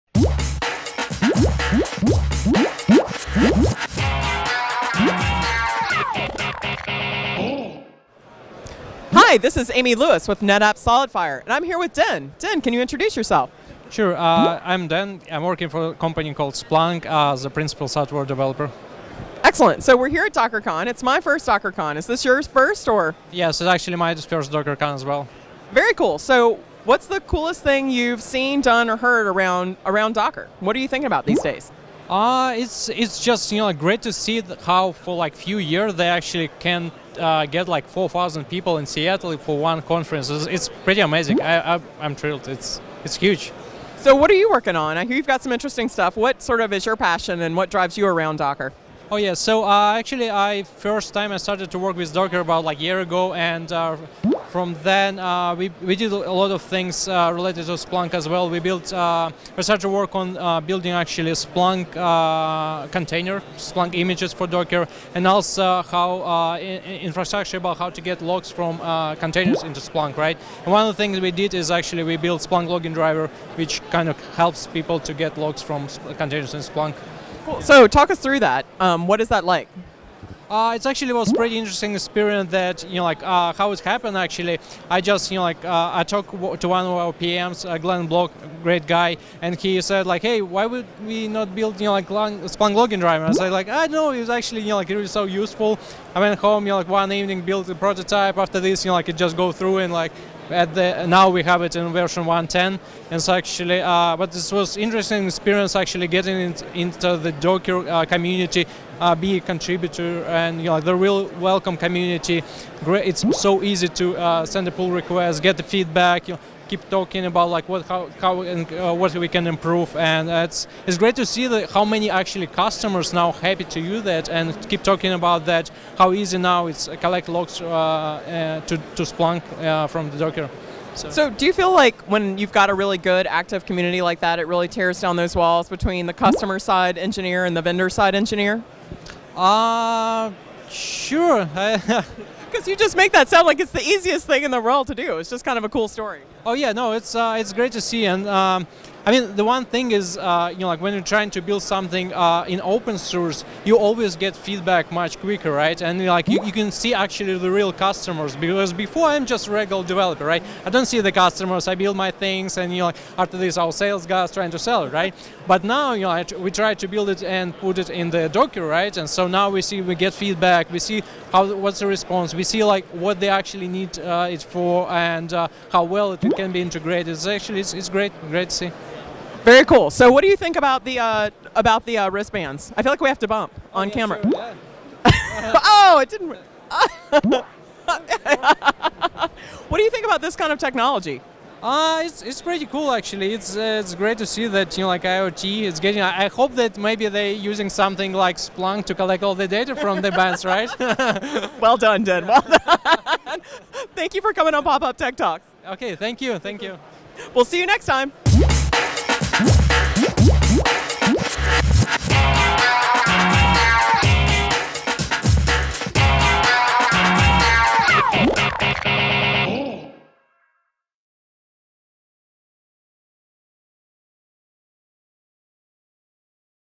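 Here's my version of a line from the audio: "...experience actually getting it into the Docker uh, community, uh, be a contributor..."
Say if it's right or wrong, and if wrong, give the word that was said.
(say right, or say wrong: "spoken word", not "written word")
right.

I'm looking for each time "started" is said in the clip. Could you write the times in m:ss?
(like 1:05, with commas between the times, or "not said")
0:51, 0:59.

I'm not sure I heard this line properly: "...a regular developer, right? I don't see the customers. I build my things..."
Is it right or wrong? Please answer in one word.
right.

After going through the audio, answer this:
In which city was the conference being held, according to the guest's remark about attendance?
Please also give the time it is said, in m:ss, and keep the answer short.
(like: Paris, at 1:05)
Seattle, at 0:38.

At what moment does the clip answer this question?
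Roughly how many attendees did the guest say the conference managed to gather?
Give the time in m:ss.
0:37.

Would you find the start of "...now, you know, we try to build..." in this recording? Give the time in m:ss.
2:45.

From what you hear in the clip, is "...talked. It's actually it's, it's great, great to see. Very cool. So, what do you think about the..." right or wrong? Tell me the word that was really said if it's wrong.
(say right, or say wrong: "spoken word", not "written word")
wrong: "integrated", not "talked".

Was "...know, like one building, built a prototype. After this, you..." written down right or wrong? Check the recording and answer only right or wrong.
wrong.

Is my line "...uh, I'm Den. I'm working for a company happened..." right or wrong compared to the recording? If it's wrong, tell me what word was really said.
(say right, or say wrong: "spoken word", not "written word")
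wrong: "called", not "happened".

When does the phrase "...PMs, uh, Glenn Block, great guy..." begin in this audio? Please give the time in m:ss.
1:27.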